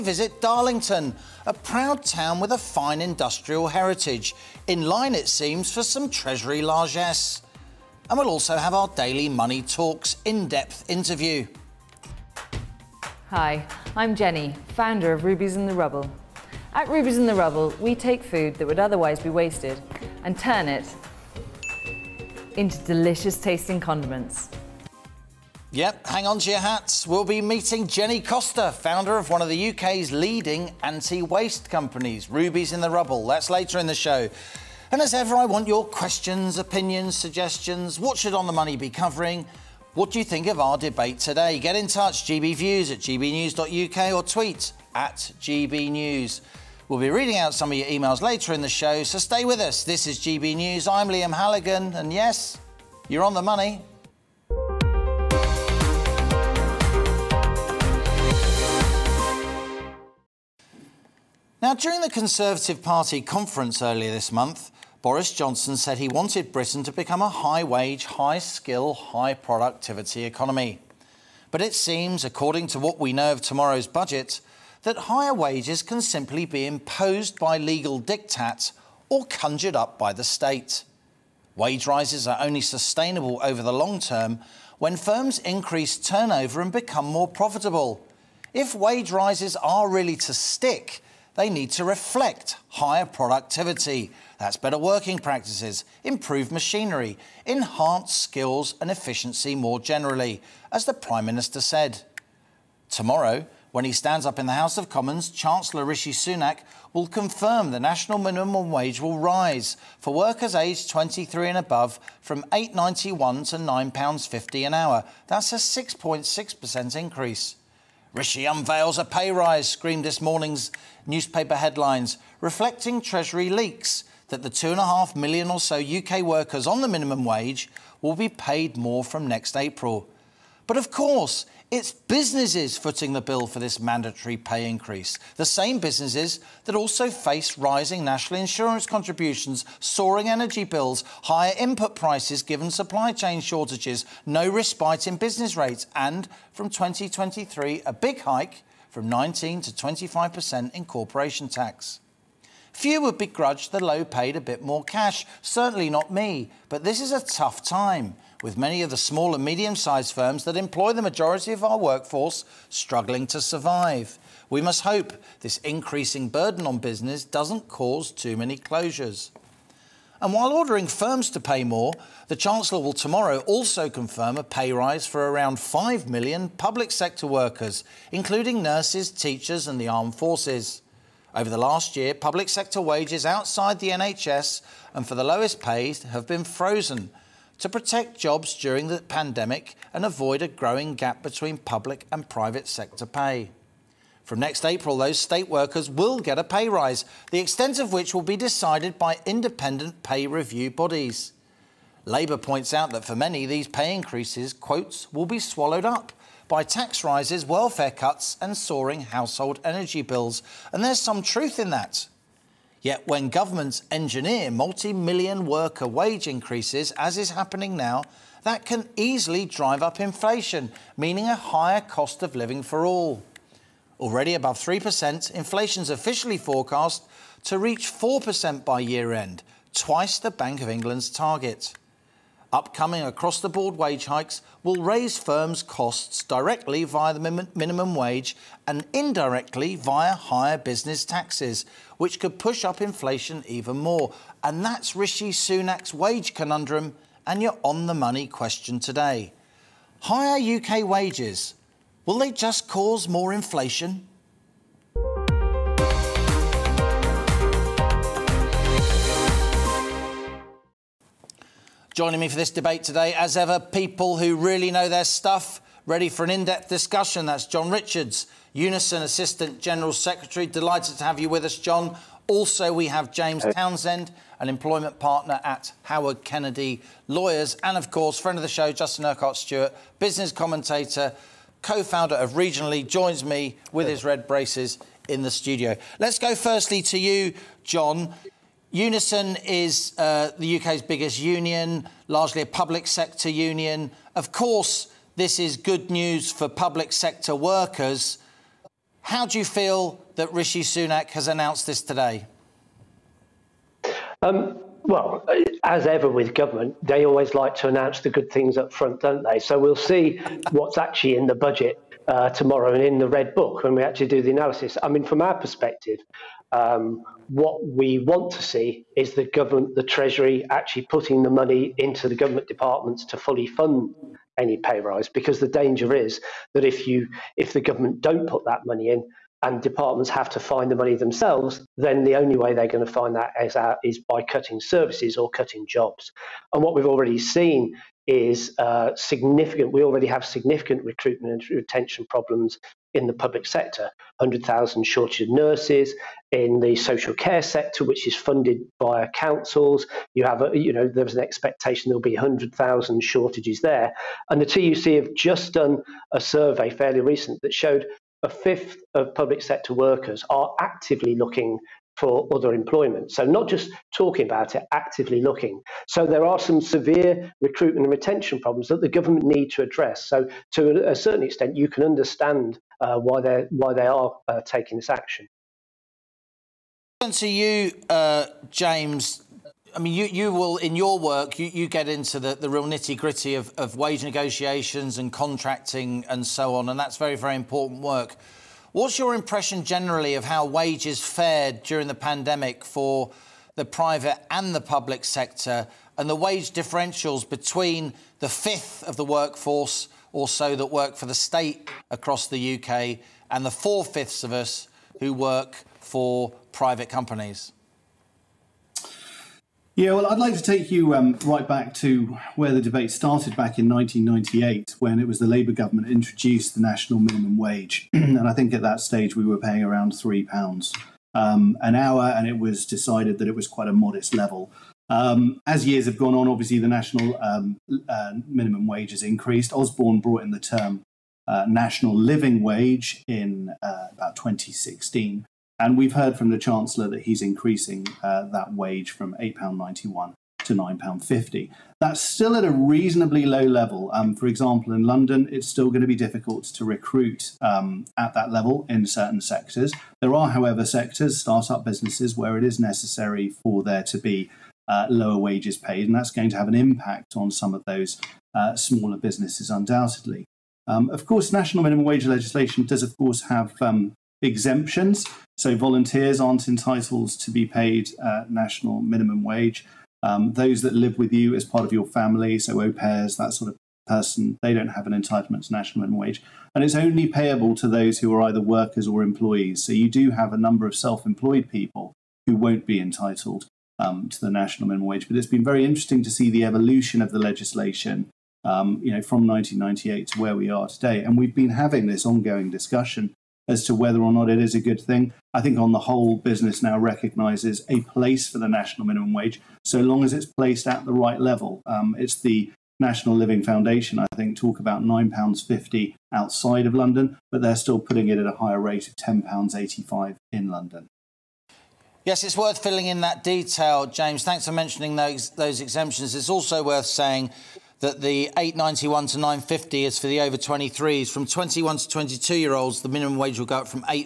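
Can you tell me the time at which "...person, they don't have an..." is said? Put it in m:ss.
7:53.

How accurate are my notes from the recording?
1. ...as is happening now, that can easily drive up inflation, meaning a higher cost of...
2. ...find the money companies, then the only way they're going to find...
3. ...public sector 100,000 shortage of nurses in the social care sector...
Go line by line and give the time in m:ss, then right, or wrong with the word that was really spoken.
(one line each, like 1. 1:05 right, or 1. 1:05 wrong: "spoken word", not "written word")
1. 3:36 right
2. 5:30 wrong: "themselves", not "companies"
3. 5:43 right.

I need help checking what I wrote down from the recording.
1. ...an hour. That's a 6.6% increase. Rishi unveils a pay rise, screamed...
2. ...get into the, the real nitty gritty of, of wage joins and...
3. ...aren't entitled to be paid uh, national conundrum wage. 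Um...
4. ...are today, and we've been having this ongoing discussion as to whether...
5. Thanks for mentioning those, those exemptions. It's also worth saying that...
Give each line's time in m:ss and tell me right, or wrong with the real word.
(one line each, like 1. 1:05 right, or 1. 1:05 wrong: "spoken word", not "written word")
1. 1:54 right
2. 6:21 wrong: "negotiations", not "joins"
3. 7:46 wrong: "minimum", not "conundrum"
4. 8:10 right
5. 8:34 right.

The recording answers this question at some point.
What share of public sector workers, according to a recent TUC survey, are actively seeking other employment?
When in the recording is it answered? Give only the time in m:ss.
5:58.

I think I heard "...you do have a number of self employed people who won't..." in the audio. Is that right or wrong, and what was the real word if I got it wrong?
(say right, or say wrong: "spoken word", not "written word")
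right.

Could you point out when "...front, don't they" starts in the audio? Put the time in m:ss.
5:08.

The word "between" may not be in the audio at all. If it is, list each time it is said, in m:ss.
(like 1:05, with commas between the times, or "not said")
3:11, 6:37.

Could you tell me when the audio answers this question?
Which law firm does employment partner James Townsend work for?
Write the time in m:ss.
4:35.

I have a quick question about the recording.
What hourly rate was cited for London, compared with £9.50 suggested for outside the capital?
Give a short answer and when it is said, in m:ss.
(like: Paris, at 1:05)
£10.85, at 8:28.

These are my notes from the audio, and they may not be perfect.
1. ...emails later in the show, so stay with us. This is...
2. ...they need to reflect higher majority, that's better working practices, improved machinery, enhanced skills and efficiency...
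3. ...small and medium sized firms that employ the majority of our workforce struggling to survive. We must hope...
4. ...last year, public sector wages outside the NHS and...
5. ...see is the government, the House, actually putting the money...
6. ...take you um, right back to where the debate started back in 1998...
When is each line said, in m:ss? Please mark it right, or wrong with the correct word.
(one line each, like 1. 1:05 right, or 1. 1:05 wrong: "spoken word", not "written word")
1. 0:47 right
2. 1:31 wrong: "productivity", not "majority"
3. 2:38 right
4. 3:01 right
5. 5:18 wrong: "Treasury", not "House"
6. 6:50 right.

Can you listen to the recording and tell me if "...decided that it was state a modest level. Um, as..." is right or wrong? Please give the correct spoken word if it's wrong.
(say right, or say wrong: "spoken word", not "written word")
wrong: "quite", not "state".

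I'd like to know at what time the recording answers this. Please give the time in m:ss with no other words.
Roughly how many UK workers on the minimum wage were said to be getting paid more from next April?
2:04.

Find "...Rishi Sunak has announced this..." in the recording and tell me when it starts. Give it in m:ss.
5:00.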